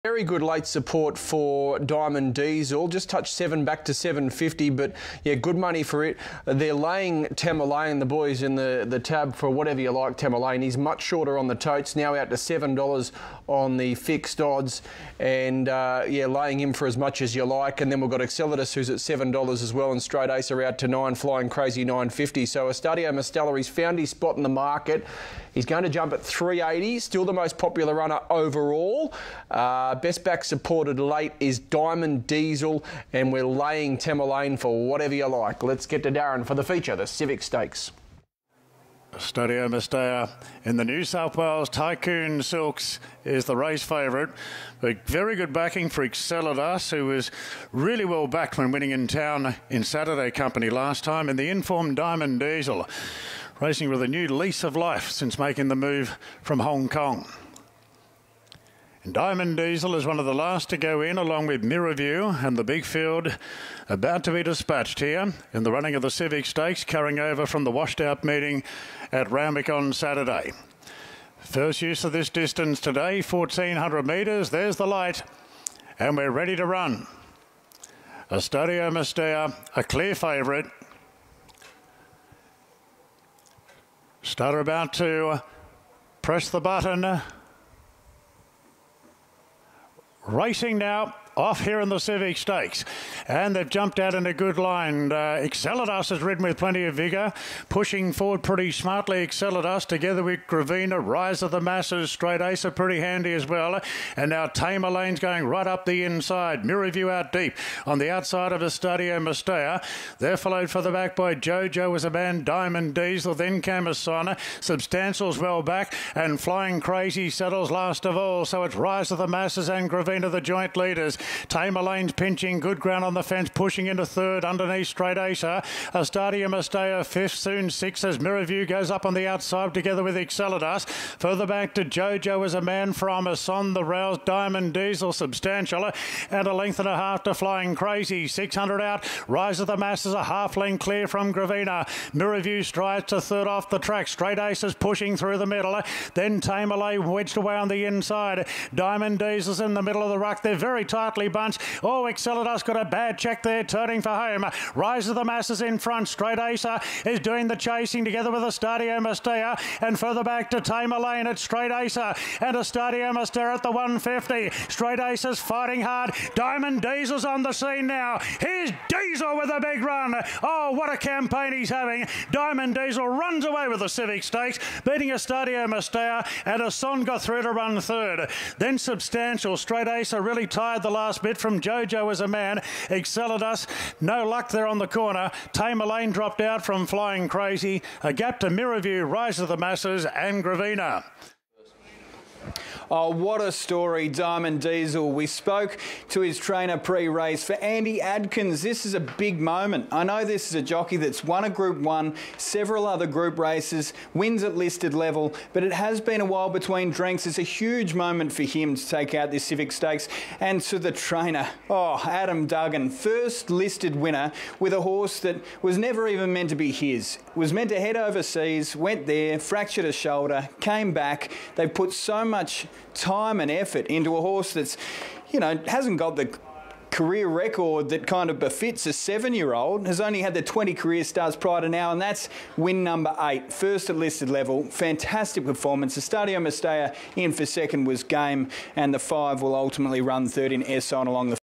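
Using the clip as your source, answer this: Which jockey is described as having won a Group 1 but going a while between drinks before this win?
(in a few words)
Andy Adkins.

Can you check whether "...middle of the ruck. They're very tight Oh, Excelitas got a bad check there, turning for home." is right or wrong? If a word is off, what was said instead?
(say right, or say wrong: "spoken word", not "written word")
right.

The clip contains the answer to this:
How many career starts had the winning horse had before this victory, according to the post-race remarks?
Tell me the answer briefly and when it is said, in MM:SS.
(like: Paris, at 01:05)
20, at 03:50.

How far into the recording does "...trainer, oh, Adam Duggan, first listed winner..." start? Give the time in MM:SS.
03:30.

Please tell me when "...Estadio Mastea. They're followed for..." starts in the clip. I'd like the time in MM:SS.
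01:48.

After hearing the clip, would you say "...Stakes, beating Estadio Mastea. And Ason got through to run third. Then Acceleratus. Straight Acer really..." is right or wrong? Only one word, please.
wrong.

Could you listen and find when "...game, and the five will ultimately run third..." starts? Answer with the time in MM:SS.
03:58.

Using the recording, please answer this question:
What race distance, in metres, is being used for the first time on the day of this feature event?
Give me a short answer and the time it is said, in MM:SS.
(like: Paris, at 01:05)
1,400 metres, at 01:13.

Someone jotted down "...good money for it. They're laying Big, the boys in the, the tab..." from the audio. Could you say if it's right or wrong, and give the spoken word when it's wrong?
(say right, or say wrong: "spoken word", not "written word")
wrong: "Tamerlane", not "Big".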